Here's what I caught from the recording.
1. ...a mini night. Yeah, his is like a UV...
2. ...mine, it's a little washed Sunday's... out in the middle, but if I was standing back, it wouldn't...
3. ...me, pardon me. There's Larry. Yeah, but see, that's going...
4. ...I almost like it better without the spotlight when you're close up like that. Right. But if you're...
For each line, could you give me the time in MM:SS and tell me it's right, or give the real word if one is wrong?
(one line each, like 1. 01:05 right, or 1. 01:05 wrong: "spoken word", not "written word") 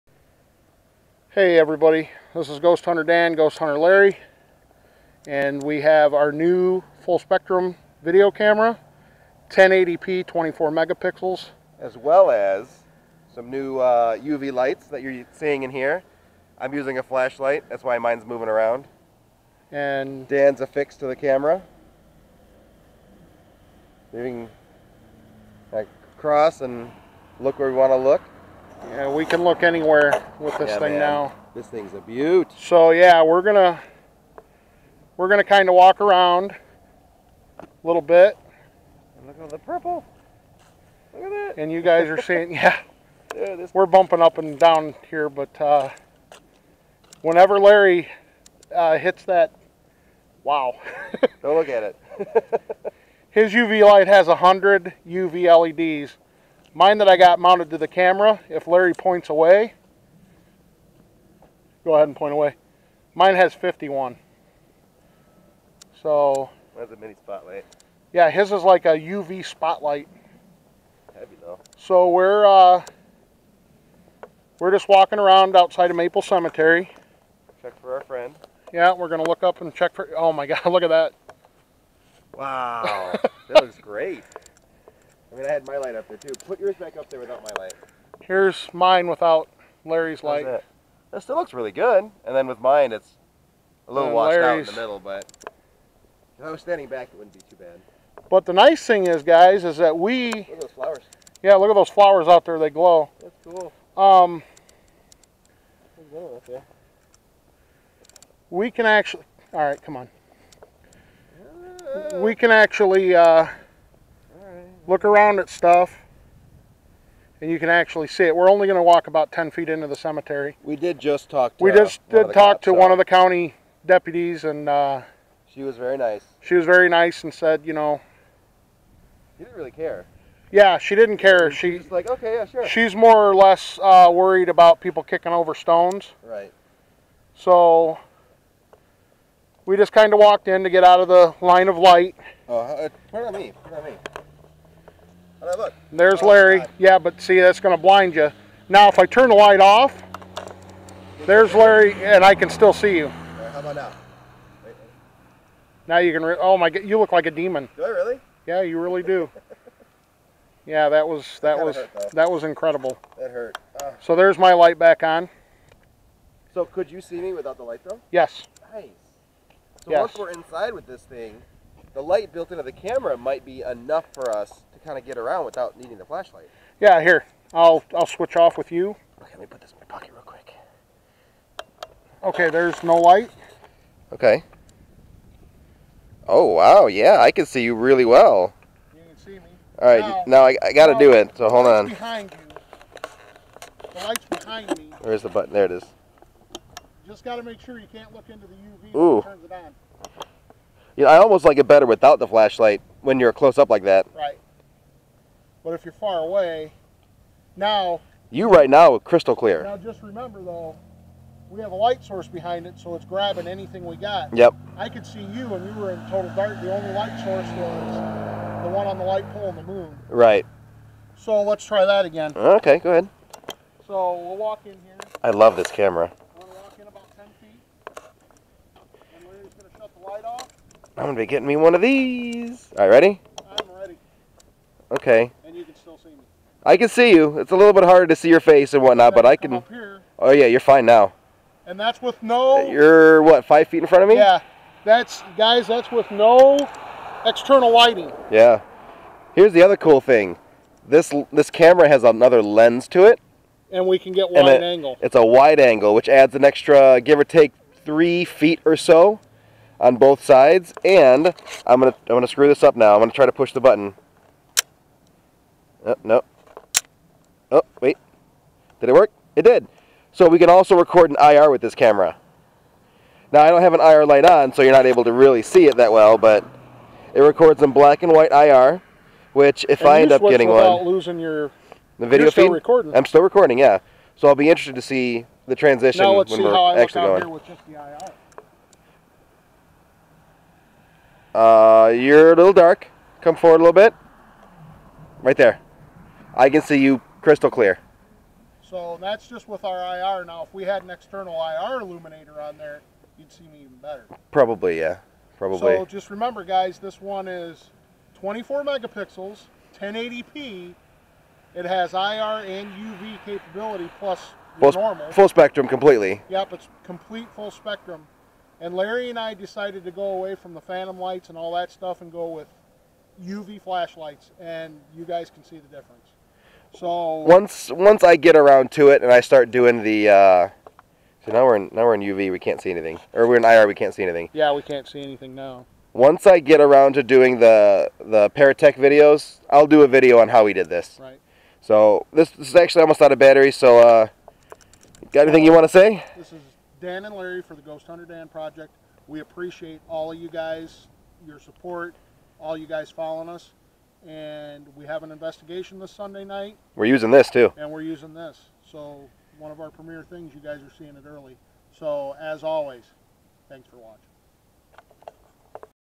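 1. 01:06 wrong: "spotlight", not "night"
2. 01:32 wrong: "Larry", not "Sunday"
3. 02:23 right
4. 03:21 wrong: "flashlight", not "spotlight".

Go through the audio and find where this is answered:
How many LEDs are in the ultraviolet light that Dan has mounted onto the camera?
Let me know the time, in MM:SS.
01:03.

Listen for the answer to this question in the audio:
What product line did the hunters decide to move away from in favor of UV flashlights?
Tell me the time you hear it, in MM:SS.
05:20.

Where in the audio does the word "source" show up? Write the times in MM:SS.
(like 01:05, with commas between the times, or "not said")
03:32, 03:37.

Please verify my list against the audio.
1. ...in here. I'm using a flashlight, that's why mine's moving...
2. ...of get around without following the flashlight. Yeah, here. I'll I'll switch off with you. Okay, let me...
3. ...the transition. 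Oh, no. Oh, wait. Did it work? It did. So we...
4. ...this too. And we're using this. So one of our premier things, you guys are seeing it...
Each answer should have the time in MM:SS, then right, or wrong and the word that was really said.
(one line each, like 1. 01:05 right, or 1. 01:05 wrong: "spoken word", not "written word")
1. 00:15 right
2. 02:54 wrong: "needing", not "following"
3. 04:23 wrong: "button", not "transition"
4. 05:57 right.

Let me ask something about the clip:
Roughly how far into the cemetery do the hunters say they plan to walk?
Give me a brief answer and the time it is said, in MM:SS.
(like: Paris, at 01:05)
10 feet, at 01:59.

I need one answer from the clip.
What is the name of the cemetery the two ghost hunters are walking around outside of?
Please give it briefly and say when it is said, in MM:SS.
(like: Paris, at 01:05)
Maple Cemetery, at 01:15.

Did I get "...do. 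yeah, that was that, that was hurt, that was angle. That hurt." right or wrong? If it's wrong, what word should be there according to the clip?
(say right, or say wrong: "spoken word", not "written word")
wrong: "incredible", not "angle".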